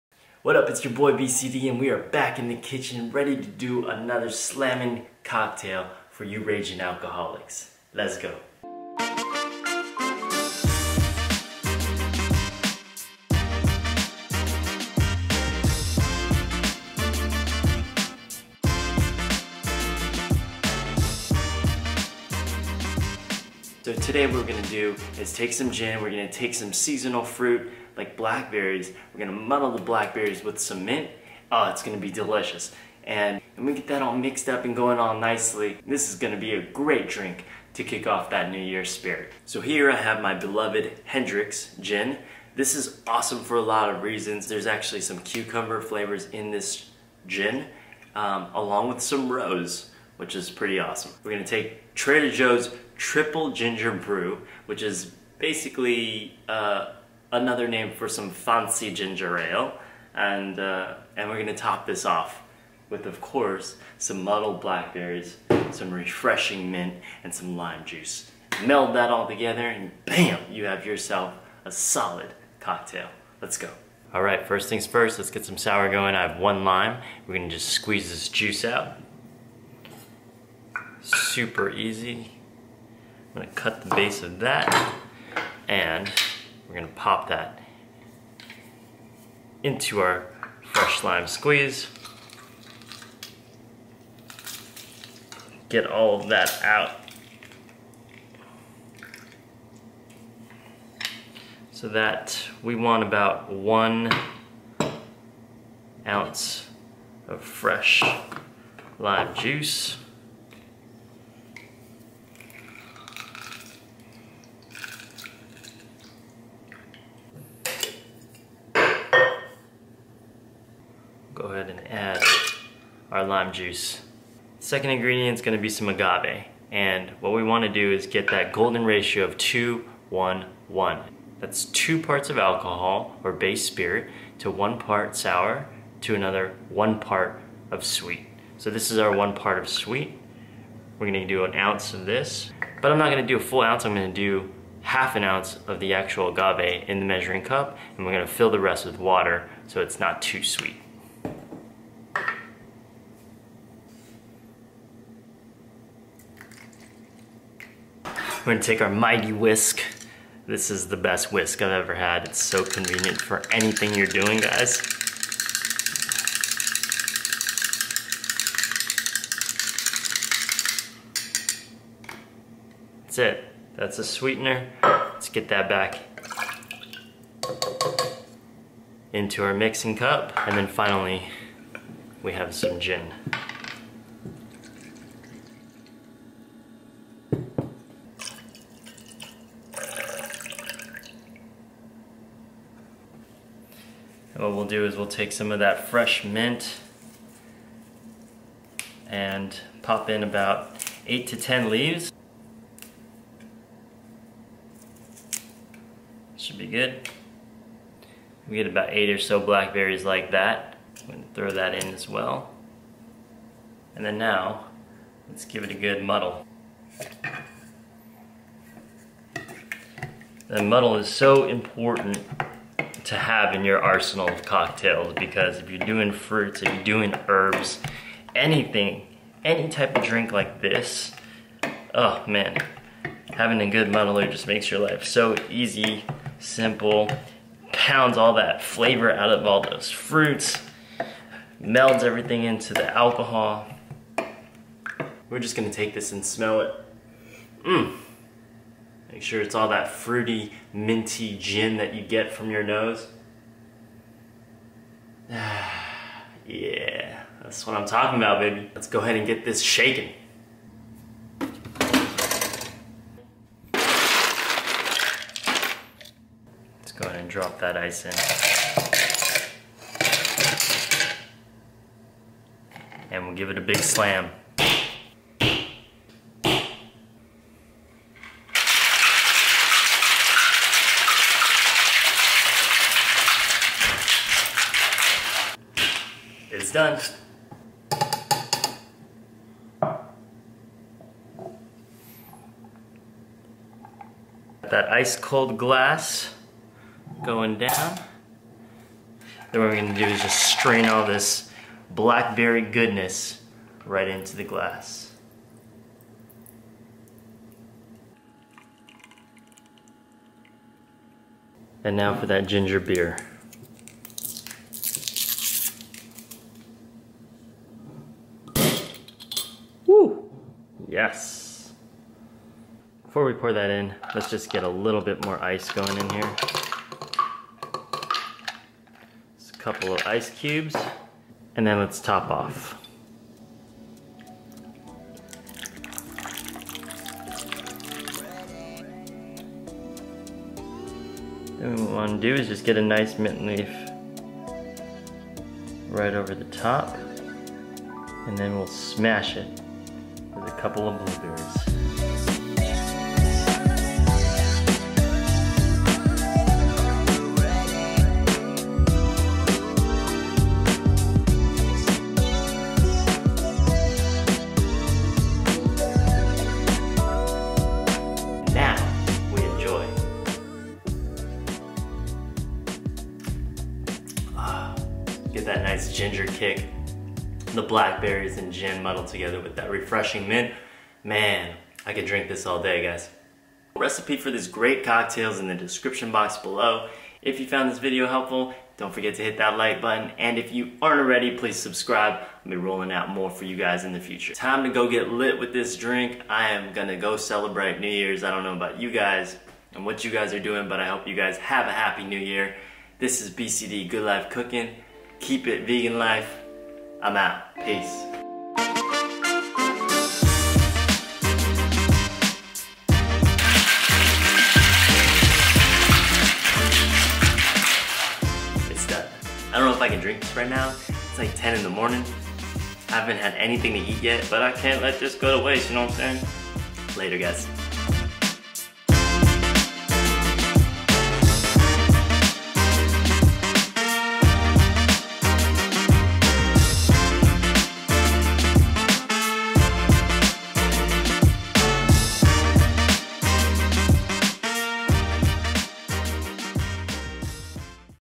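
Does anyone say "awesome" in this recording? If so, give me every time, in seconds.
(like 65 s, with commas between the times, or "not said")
43 s, 50 s.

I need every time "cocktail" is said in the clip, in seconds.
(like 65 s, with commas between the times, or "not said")
5 s, 72 s, 224 s, 384 s.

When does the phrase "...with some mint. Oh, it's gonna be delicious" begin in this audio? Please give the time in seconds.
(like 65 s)
30 s.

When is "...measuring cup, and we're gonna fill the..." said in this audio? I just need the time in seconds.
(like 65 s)
147 s.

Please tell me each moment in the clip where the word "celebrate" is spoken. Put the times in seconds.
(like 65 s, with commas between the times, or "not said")
397 s.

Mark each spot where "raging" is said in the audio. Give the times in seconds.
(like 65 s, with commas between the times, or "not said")
6 s.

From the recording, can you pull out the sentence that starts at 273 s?
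And we'll give it a big slam.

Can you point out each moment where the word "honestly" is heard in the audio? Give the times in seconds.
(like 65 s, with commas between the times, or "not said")
not said.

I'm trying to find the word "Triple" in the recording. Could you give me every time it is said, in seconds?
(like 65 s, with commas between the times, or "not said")
52 s.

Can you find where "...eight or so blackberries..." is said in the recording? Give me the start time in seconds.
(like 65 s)
208 s.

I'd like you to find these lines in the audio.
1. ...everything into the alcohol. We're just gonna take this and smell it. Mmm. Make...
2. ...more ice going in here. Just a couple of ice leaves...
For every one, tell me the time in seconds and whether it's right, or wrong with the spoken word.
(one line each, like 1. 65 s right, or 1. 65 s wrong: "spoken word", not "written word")
1. 242 s right
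2. 325 s wrong: "cubes", not "leaves".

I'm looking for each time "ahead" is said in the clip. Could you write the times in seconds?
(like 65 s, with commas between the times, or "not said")
259 s, 267 s.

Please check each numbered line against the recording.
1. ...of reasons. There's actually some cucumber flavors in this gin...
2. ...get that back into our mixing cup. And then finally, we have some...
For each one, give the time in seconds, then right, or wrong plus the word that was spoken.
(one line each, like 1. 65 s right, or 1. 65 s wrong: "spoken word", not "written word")
1. 43 s right
2. 175 s right.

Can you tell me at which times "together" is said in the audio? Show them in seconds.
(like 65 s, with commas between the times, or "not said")
69 s, 379 s.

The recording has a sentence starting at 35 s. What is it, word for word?
This is gonna be a great drink to kick off that New Year's spirit.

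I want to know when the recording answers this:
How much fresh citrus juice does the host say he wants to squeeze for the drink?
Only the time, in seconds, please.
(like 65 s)
103 s.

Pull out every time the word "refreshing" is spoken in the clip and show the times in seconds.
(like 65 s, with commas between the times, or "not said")
65 s, 379 s.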